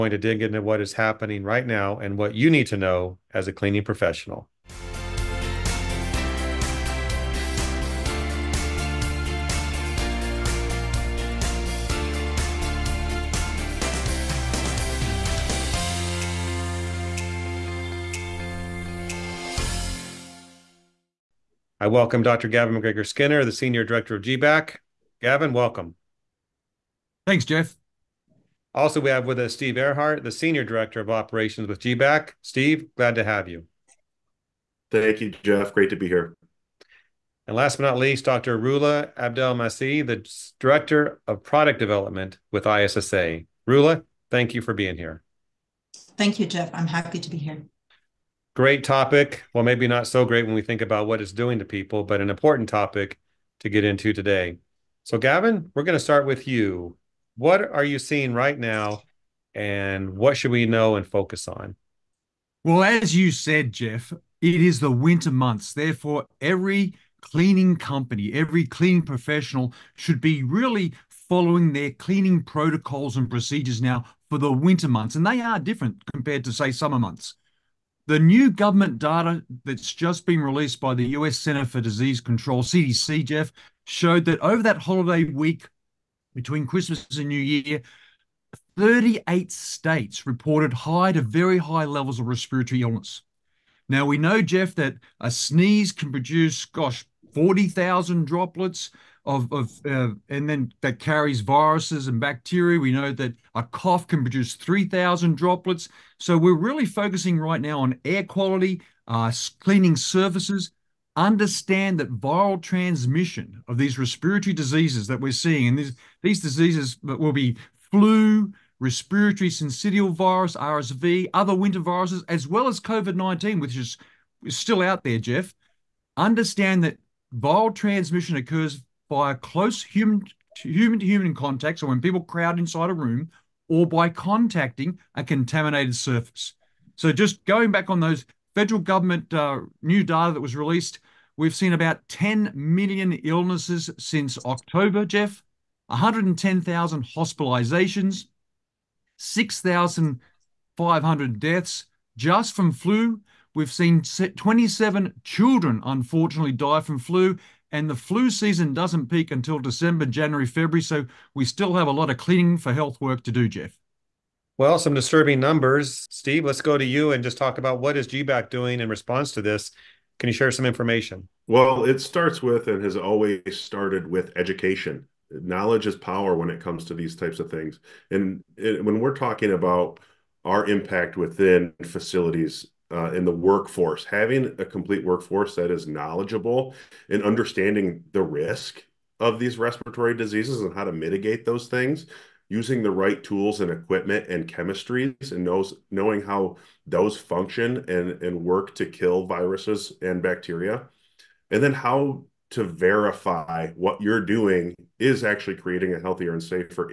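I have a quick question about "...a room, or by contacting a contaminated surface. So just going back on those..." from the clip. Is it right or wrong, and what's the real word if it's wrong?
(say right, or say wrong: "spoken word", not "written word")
right.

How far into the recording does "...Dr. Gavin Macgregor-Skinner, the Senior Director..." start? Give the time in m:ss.
0:22.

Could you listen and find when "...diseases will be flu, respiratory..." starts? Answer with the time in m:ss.
1:56.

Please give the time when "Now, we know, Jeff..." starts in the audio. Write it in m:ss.
1:33.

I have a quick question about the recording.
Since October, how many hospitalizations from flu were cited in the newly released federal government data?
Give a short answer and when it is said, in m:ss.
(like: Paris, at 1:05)
110,000, at 2:25.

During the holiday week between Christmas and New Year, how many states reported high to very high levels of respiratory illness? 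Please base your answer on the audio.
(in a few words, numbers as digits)
38.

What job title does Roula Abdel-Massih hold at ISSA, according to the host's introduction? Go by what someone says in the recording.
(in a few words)
Director of Product Development.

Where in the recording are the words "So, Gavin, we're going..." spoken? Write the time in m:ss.
0:55.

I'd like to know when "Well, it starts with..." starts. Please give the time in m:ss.
2:51.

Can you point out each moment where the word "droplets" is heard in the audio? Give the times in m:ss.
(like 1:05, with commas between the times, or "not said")
1:38, 1:45.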